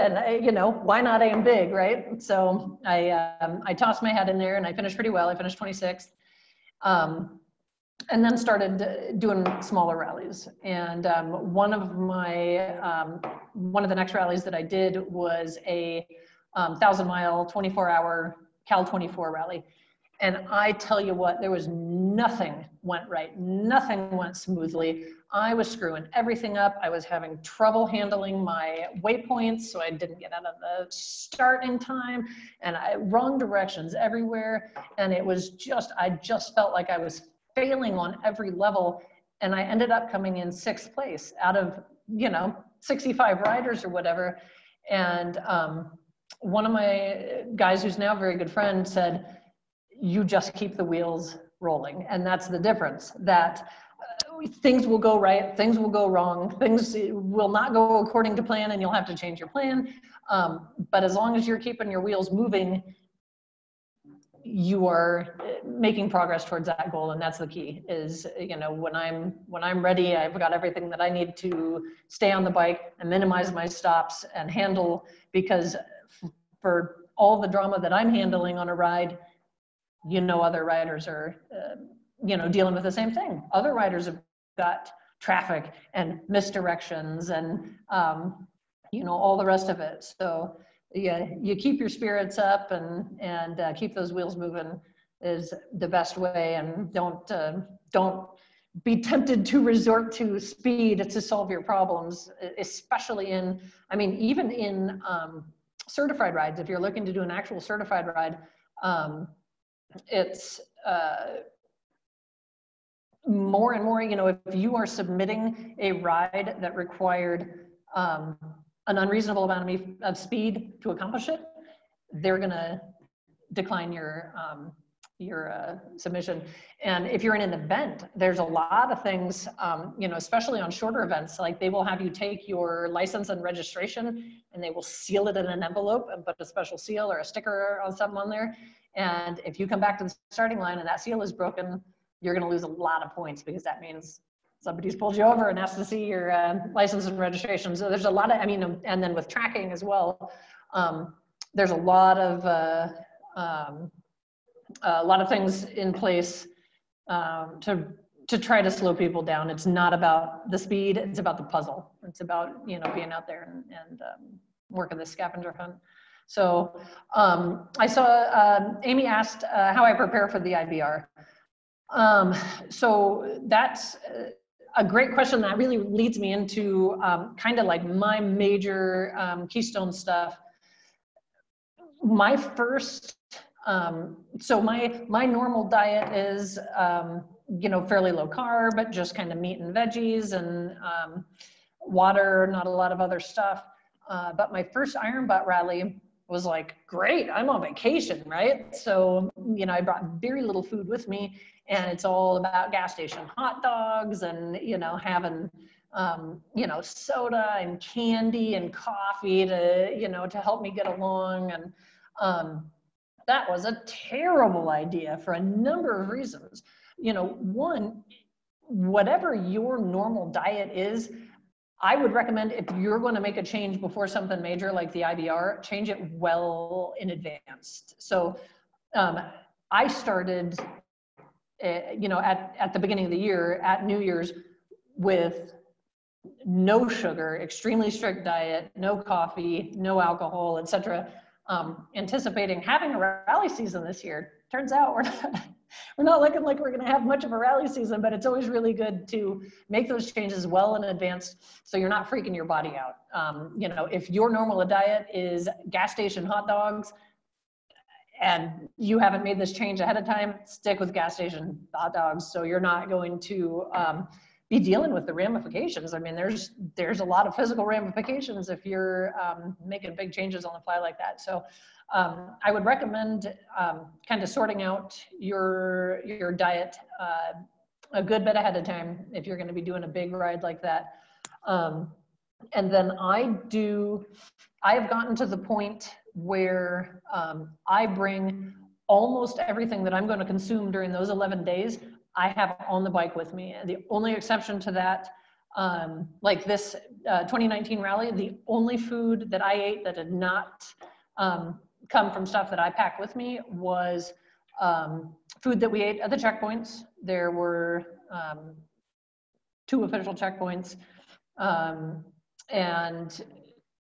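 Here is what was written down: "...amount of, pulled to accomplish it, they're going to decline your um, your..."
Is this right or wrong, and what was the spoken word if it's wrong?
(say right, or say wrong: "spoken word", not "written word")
wrong: "speed", not "pulled".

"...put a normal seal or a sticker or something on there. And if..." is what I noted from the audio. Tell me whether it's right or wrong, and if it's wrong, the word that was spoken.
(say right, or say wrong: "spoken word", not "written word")
wrong: "special", not "normal".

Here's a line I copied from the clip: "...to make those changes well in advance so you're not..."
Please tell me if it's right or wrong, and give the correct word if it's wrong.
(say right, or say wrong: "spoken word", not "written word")
right.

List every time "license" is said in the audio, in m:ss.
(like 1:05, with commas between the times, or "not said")
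2:12, 2:26.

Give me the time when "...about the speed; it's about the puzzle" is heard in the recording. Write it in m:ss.
2:39.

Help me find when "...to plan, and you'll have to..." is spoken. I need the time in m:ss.
0:58.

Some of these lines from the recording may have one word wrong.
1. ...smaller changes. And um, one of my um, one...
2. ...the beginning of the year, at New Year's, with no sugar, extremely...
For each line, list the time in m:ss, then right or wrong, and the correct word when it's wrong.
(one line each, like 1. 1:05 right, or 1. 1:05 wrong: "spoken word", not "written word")
1. 0:09 wrong: "rallies", not "changes"
2. 3:52 right.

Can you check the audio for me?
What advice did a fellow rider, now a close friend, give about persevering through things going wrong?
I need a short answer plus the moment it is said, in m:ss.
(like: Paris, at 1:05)
Keep the wheels rolling, at 0:50.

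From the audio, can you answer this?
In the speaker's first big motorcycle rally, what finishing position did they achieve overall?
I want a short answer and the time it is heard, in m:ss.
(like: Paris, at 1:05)
26th, at 0:05.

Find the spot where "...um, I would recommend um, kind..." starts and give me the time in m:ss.
4:31.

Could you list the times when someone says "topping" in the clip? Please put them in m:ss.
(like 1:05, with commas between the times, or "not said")
not said.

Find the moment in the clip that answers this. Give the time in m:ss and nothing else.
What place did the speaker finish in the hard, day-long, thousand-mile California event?
0:40.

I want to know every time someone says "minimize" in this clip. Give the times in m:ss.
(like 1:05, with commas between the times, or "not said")
1:13.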